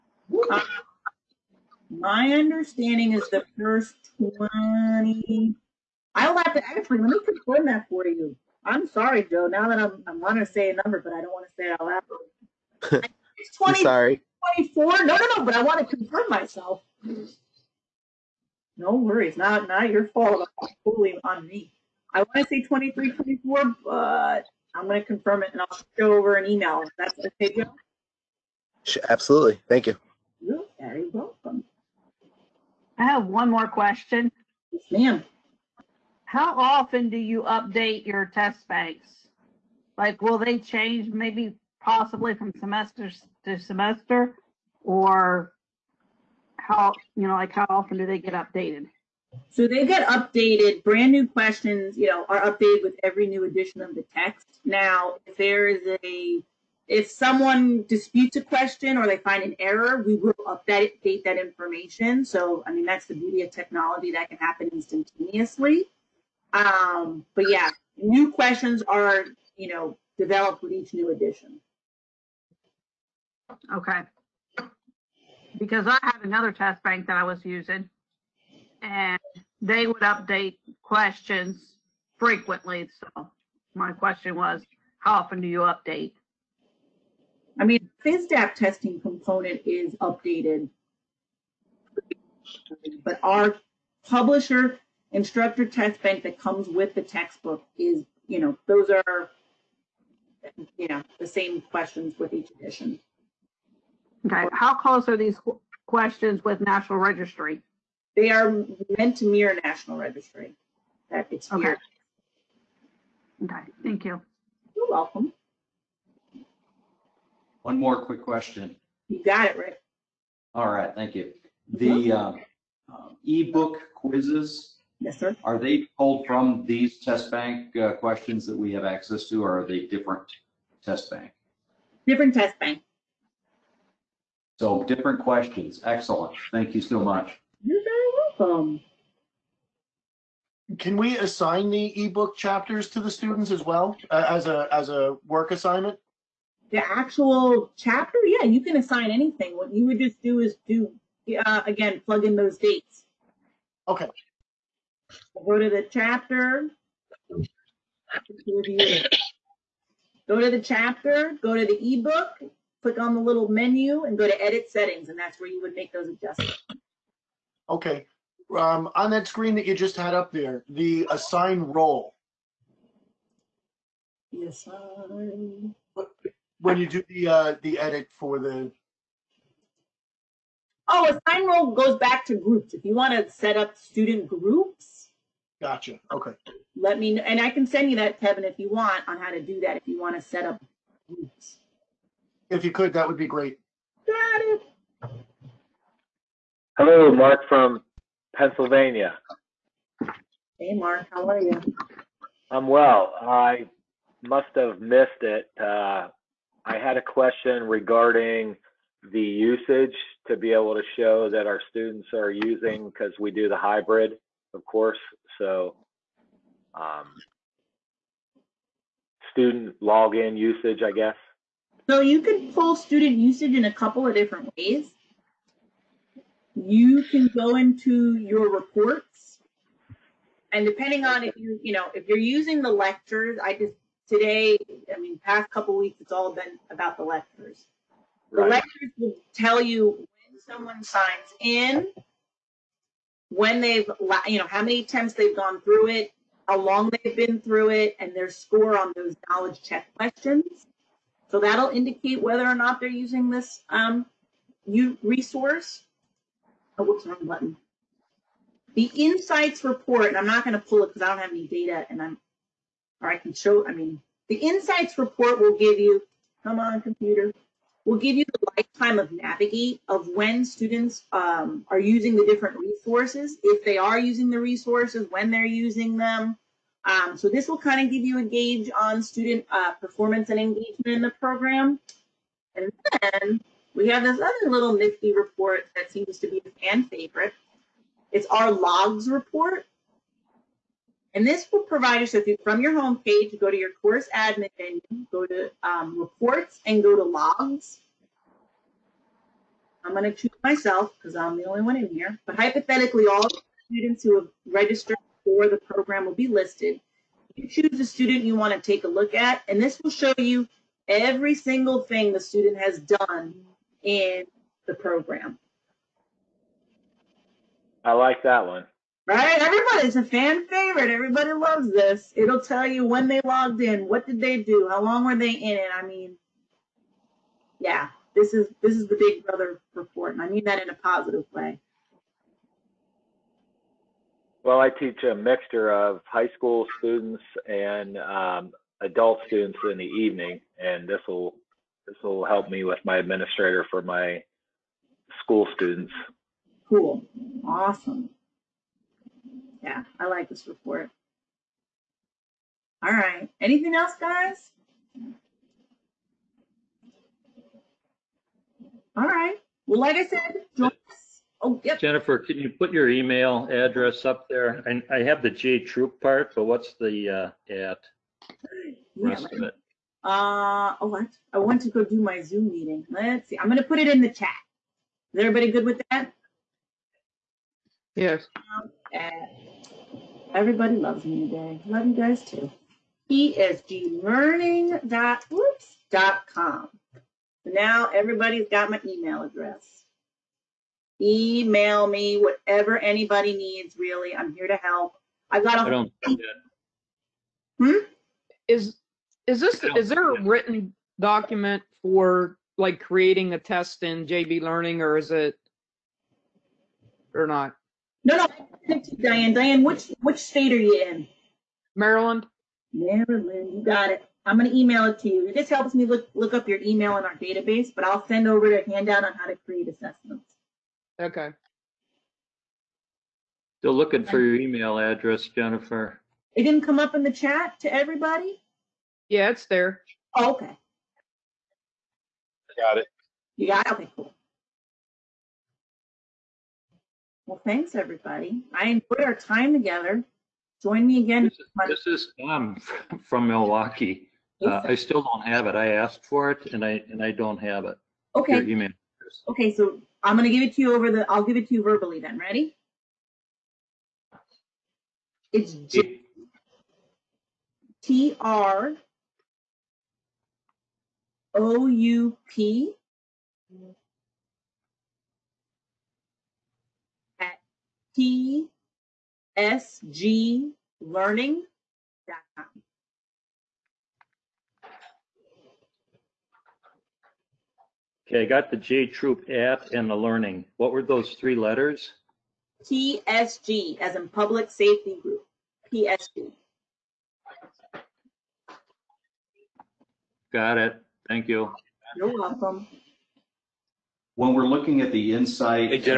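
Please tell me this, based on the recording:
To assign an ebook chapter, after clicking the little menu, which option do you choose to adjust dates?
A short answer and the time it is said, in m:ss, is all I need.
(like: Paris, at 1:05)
edit settings, at 2:44.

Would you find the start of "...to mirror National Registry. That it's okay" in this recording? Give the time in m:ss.
1:49.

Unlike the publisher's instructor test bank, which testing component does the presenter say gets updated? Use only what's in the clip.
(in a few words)
FISDAP.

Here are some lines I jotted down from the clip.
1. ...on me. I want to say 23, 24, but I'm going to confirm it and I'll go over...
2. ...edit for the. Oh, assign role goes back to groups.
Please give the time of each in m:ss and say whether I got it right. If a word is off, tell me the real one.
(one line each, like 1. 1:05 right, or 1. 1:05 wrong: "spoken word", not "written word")
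1. 0:21 right
2. 2:57 right.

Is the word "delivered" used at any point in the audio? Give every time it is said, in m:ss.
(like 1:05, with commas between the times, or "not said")
not said.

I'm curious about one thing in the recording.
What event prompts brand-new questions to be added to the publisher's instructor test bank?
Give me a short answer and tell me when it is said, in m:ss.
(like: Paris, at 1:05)
every new edition of the text, at 0:53.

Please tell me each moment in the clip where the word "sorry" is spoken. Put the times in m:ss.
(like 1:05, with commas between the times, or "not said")
0:08, 0:13.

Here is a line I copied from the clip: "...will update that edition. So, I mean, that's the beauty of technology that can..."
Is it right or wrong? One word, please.
wrong.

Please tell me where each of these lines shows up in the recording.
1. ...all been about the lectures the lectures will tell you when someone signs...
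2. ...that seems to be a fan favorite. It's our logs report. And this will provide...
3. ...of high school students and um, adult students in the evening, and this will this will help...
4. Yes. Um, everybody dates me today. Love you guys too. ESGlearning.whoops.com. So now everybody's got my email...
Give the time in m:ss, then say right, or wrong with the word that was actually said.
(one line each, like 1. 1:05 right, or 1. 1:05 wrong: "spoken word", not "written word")
1. 3:56 right
2. 4:45 right
3. 5:35 right
4. 6:17 wrong: "loves", not "dates".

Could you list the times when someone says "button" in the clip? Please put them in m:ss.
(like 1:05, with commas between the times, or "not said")
4:17.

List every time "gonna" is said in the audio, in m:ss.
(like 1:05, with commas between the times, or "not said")
6:54, 7:30.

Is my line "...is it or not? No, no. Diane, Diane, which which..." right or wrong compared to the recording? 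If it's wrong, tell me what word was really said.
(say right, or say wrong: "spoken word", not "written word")
right.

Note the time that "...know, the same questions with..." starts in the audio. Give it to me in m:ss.
1:40.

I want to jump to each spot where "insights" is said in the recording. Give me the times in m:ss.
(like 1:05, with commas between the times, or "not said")
4:18, 4:24, 8:15.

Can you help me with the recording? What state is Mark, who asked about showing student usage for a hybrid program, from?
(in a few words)
Pennsylvania.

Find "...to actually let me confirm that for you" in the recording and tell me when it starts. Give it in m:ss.
0:06.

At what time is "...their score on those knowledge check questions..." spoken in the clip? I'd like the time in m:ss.
4:08.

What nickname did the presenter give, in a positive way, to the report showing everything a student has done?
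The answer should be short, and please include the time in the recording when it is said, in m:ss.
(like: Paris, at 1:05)
Big Brother report, at 5:28.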